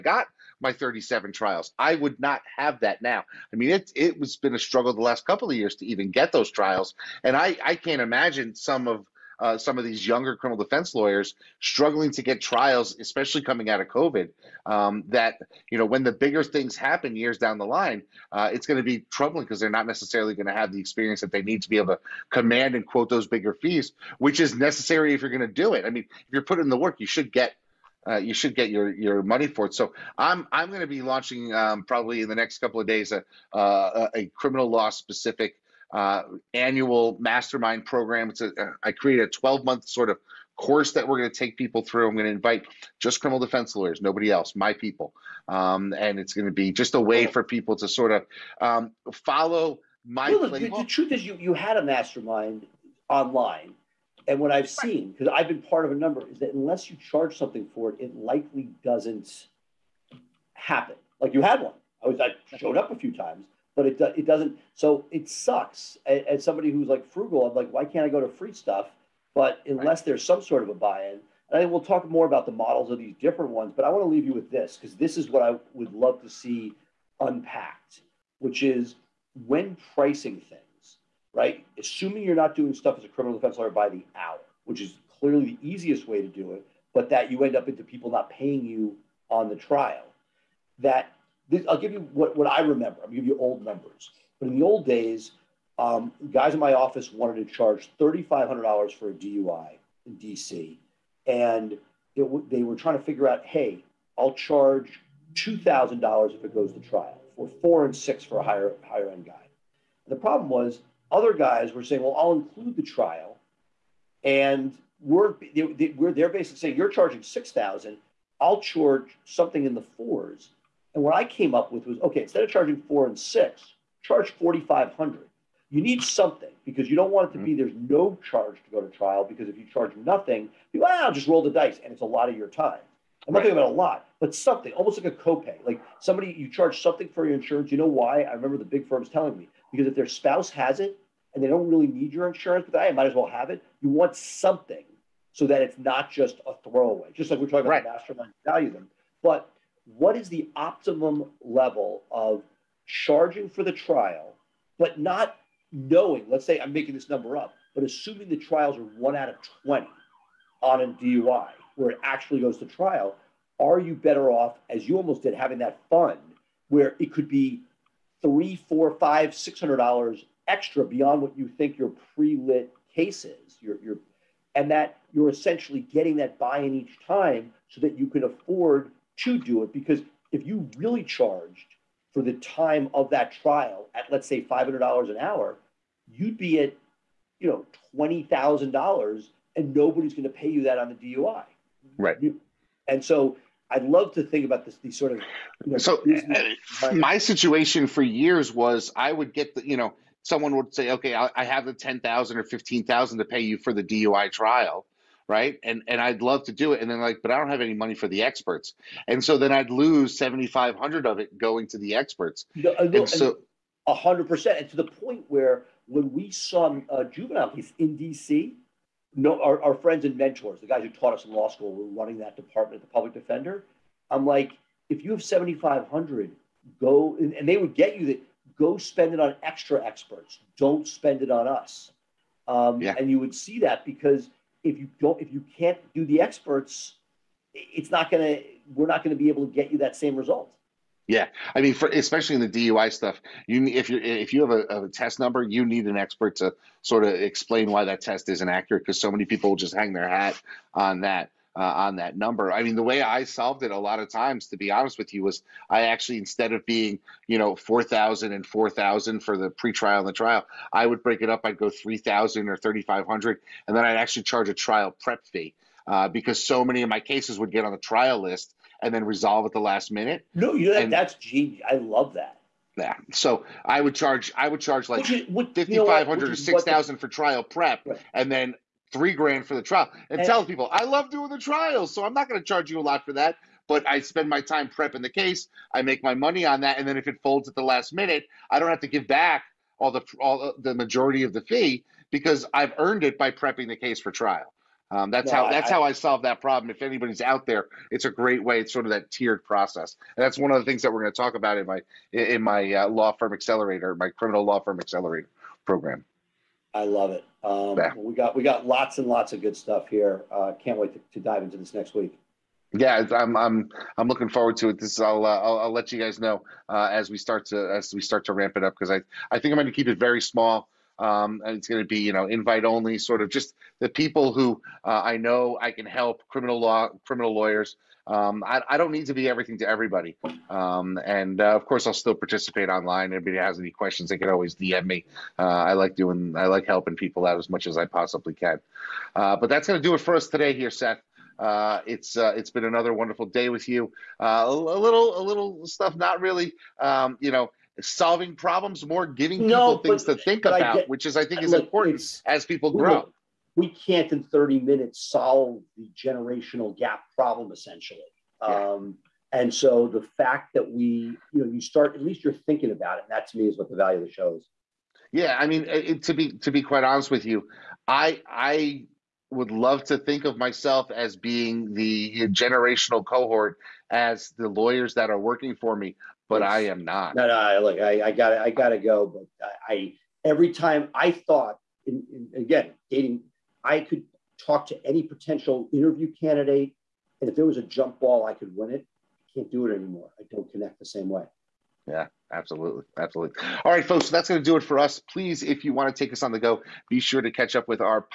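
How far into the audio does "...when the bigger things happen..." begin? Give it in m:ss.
0:15.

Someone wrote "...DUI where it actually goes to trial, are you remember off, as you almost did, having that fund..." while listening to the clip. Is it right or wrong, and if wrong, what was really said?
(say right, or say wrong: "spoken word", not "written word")
wrong: "better", not "remember".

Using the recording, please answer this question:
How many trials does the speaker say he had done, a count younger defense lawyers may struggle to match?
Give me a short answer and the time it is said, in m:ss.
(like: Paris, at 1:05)
37, at 0:00.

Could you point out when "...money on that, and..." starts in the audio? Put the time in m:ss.
4:46.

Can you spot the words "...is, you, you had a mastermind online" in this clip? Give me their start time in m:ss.
0:51.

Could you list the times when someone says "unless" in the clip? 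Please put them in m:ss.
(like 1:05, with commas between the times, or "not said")
0:56, 1:09.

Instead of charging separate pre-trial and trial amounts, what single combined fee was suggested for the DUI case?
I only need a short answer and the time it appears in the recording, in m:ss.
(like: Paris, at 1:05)
4,500, at 2:04.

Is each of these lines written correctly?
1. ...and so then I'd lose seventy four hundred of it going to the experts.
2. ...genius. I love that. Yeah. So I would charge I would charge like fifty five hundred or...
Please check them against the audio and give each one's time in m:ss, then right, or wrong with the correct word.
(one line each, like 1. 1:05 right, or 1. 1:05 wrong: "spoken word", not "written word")
1. 3:29 wrong: "five", not "four"
2. 4:31 right.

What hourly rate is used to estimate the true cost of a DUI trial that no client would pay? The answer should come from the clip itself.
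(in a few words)
$500.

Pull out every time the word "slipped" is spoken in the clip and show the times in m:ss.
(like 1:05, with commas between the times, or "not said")
not said.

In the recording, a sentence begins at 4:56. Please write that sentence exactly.
If anybody's out there, it's a great way.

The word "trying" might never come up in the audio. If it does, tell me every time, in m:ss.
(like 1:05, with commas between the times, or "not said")
1:42.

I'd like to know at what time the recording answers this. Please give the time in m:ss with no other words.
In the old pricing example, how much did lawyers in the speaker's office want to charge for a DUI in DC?
1:37.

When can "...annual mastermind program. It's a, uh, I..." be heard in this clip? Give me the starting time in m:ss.
0:36.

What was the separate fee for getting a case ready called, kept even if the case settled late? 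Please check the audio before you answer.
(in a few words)
trial prep fee.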